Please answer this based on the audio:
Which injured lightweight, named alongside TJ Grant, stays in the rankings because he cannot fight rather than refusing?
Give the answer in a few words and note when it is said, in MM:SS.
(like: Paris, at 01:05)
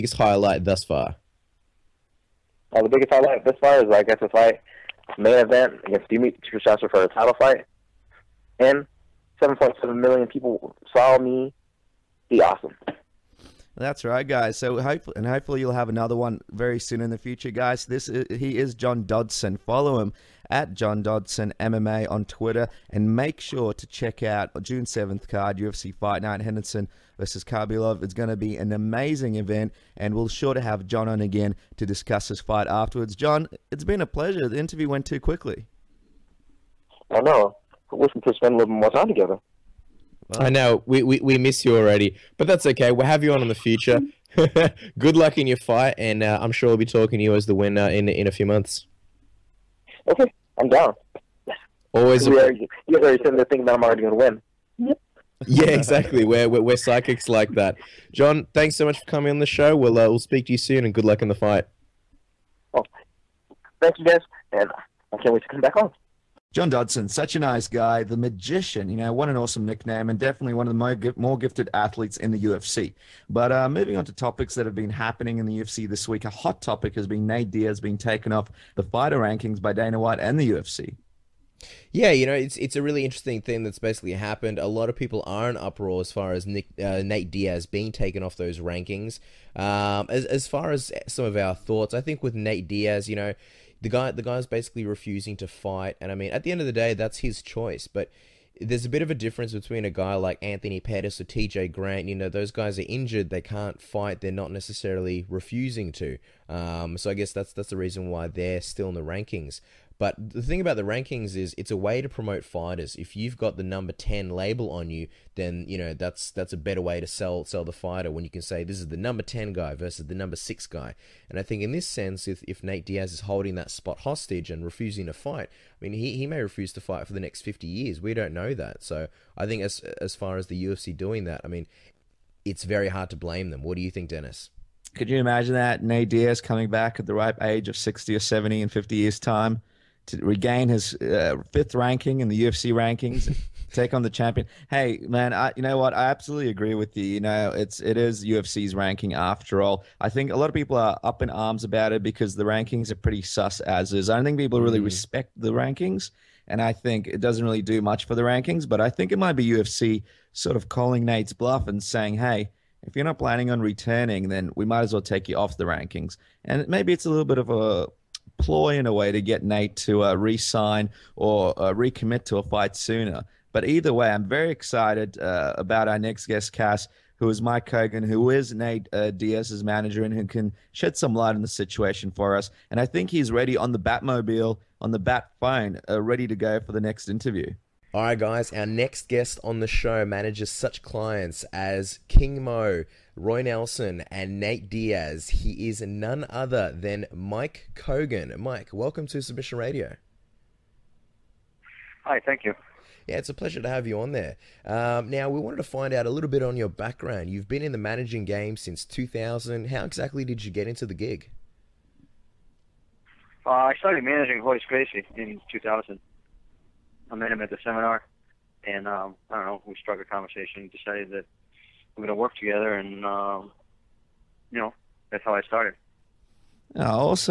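Anthony Pettis, at 01:40.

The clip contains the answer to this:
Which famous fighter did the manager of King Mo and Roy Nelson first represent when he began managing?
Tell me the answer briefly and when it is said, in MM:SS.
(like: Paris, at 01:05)
Royce Gracie, at 03:34.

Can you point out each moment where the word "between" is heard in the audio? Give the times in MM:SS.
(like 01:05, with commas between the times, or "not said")
01:39.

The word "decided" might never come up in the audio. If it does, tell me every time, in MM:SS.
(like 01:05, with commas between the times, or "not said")
03:40.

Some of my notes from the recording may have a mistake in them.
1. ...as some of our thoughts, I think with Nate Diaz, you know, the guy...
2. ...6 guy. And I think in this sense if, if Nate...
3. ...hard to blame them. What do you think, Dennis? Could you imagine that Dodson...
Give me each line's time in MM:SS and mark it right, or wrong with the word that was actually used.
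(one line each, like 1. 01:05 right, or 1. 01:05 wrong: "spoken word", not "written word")
1. 01:30 right
2. 02:00 right
3. 02:12 wrong: "Nate", not "Dodson".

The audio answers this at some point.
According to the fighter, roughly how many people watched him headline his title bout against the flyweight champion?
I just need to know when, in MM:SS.
00:09.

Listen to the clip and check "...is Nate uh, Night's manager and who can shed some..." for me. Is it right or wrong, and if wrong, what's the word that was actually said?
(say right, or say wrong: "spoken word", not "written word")
wrong: "Diaz", not "Night".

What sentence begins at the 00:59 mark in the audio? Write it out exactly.
We'll uh, we'll speak to you soon, and good luck in the fight.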